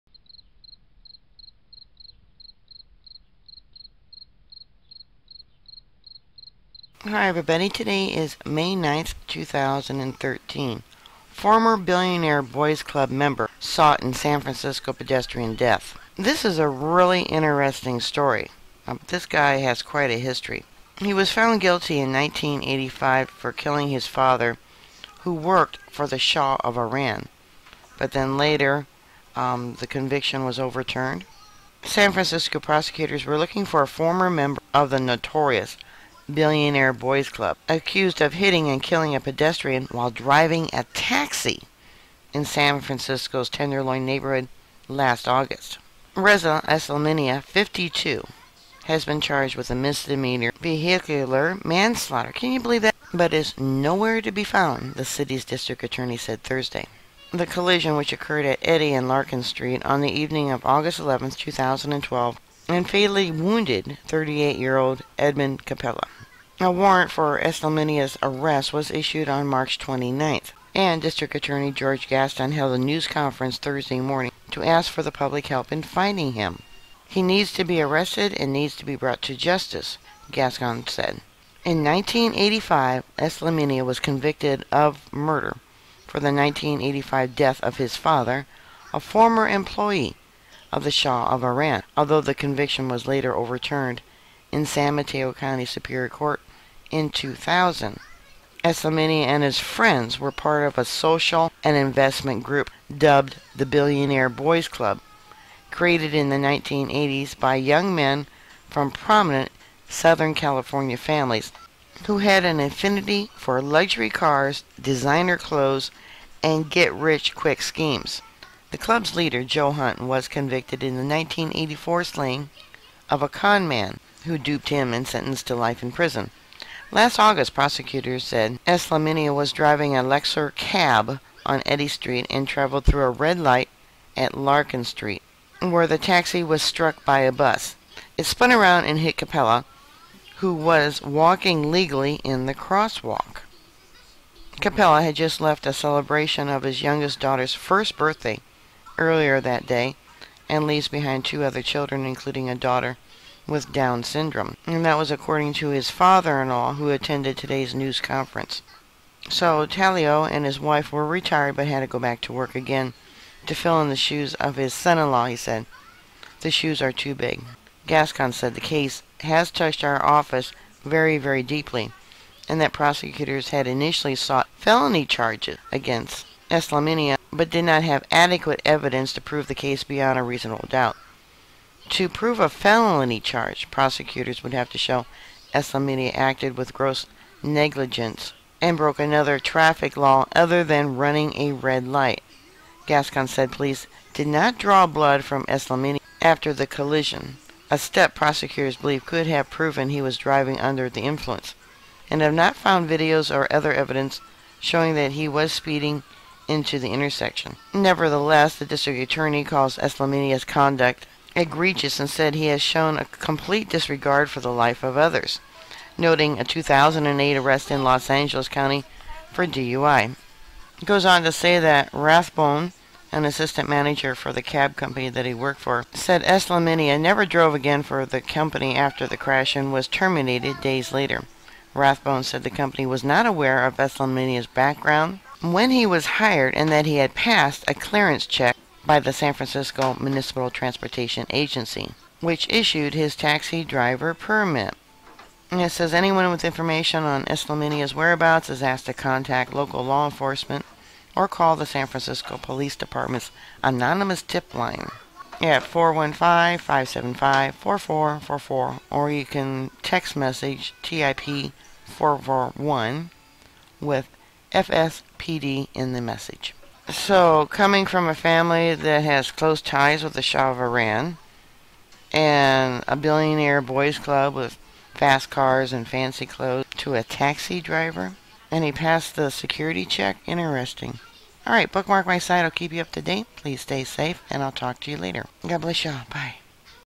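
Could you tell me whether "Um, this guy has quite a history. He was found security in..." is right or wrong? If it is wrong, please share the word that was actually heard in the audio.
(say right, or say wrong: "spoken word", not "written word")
wrong: "guilty", not "security".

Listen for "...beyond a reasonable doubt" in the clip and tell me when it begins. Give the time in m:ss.
2:59.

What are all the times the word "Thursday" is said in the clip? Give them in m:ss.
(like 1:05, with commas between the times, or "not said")
0:56, 1:13.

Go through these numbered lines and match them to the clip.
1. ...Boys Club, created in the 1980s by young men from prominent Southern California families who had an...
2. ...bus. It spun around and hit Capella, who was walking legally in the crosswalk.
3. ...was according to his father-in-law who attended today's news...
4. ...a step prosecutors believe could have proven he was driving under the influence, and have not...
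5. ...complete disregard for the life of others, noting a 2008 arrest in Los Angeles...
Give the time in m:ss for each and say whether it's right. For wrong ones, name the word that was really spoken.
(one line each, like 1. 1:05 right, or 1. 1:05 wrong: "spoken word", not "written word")
1. 1:44 right
2. 2:17 right
3. 2:34 right
4. 3:17 right
5. 3:33 right.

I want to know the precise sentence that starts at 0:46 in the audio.
Reza Eslaminia, 52, has been charged with a misdemeanor vehicular manslaughter.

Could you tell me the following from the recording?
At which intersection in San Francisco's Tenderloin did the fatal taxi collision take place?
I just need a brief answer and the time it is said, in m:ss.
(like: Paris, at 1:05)
Eddy and Larkin Street, at 0:58.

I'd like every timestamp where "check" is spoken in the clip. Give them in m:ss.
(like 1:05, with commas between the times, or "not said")
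3:58, 4:39.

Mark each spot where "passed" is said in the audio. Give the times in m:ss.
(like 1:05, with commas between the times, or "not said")
3:57, 4:38.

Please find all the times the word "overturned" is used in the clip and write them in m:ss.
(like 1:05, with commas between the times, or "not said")
0:30, 1:33.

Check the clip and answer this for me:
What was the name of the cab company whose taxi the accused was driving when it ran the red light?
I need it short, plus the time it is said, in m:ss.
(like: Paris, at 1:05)
Luxor, at 2:10.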